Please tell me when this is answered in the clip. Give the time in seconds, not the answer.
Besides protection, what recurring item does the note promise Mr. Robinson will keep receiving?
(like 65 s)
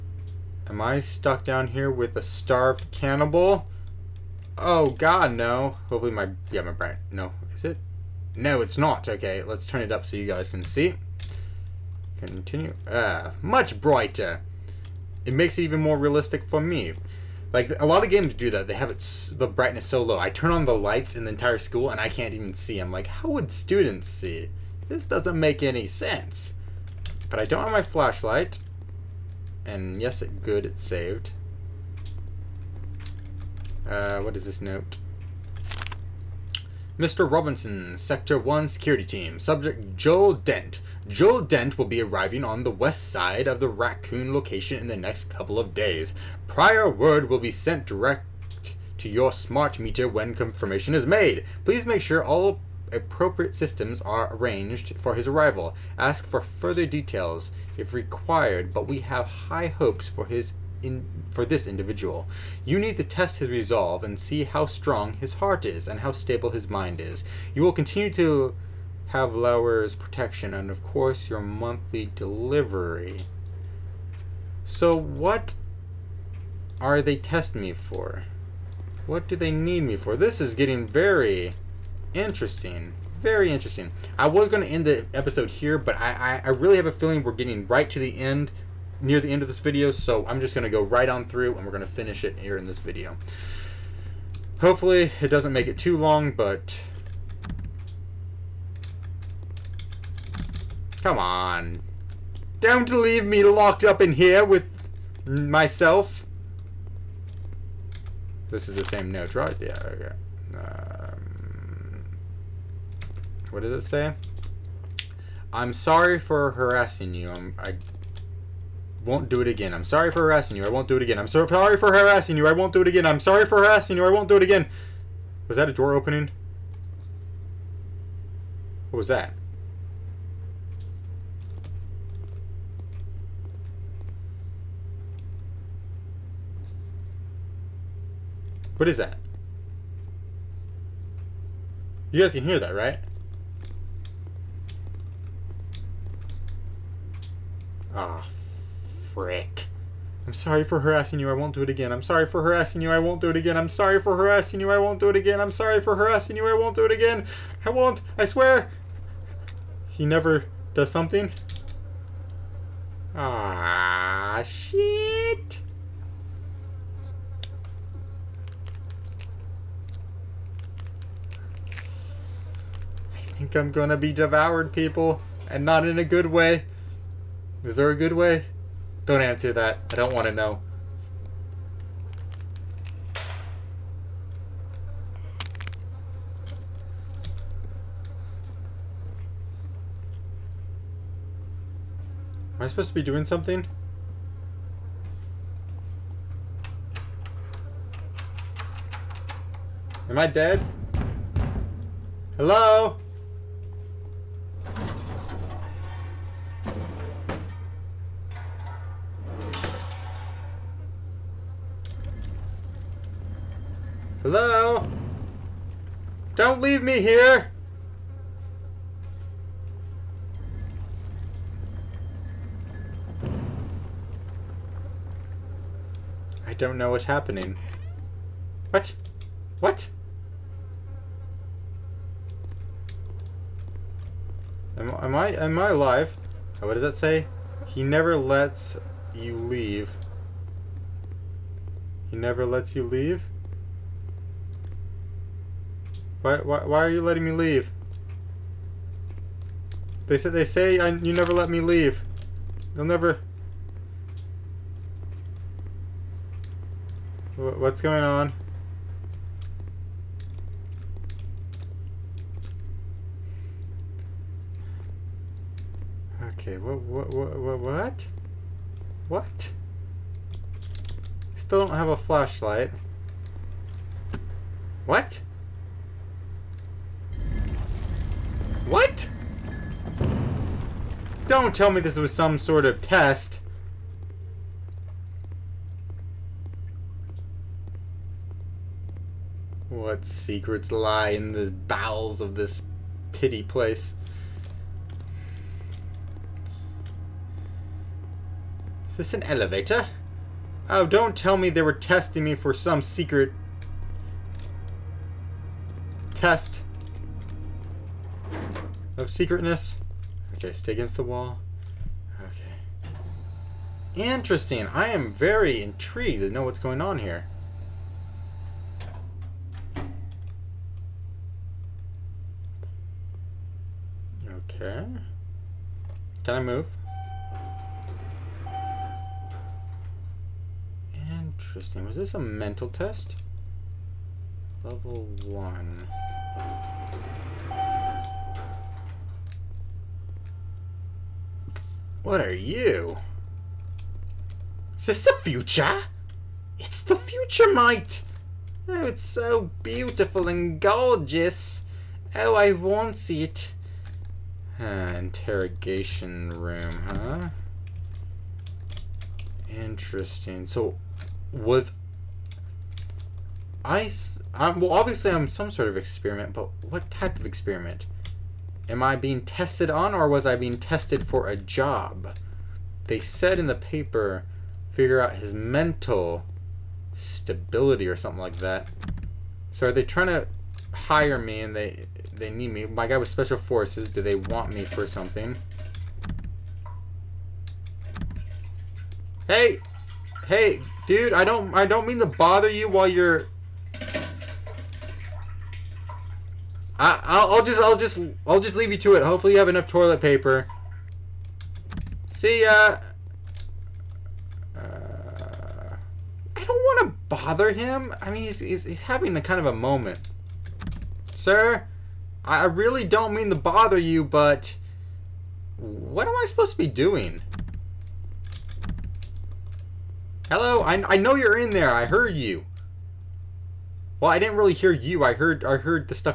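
71 s.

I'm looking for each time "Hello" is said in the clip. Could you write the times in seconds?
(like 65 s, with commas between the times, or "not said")
202 s, 420 s.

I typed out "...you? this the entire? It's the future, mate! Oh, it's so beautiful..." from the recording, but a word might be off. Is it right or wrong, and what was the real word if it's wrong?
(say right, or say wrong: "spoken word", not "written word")
wrong: "future", not "entire".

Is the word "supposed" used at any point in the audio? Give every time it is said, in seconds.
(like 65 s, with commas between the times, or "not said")
192 s, 416 s.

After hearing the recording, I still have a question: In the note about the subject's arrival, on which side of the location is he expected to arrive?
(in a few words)
west side.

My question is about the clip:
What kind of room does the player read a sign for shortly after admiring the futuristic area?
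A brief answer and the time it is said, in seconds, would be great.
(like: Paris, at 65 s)
interrogation room, at 354 s.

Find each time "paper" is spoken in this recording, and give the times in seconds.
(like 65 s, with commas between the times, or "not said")
373 s, 400 s.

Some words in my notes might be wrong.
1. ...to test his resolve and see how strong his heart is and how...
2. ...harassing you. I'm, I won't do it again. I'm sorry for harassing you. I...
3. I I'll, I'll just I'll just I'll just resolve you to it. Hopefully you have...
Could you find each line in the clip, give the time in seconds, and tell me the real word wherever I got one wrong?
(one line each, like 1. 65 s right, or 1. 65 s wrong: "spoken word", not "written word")
1. 62 s right
2. 116 s right
3. 396 s wrong: "leave", not "resolve".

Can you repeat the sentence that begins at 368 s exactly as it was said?
Am I being tested on, or was I being tested for a job?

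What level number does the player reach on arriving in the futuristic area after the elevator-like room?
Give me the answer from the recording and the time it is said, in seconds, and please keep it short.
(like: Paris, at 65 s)
1, at 334 s.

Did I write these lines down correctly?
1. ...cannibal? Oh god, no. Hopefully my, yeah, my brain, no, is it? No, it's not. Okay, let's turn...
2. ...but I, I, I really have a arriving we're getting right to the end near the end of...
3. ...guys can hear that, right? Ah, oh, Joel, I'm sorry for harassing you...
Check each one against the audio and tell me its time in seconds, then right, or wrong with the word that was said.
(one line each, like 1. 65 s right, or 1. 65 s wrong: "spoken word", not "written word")
1. 2 s right
2. 85 s wrong: "feeling", not "arriving"
3. 142 s wrong: "Brick", not "Joel".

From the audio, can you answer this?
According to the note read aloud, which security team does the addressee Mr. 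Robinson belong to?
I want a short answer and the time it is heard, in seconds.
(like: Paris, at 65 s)
Sector 1, at 37 s.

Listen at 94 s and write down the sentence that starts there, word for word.
Hopefully it doesn't make it too long, but...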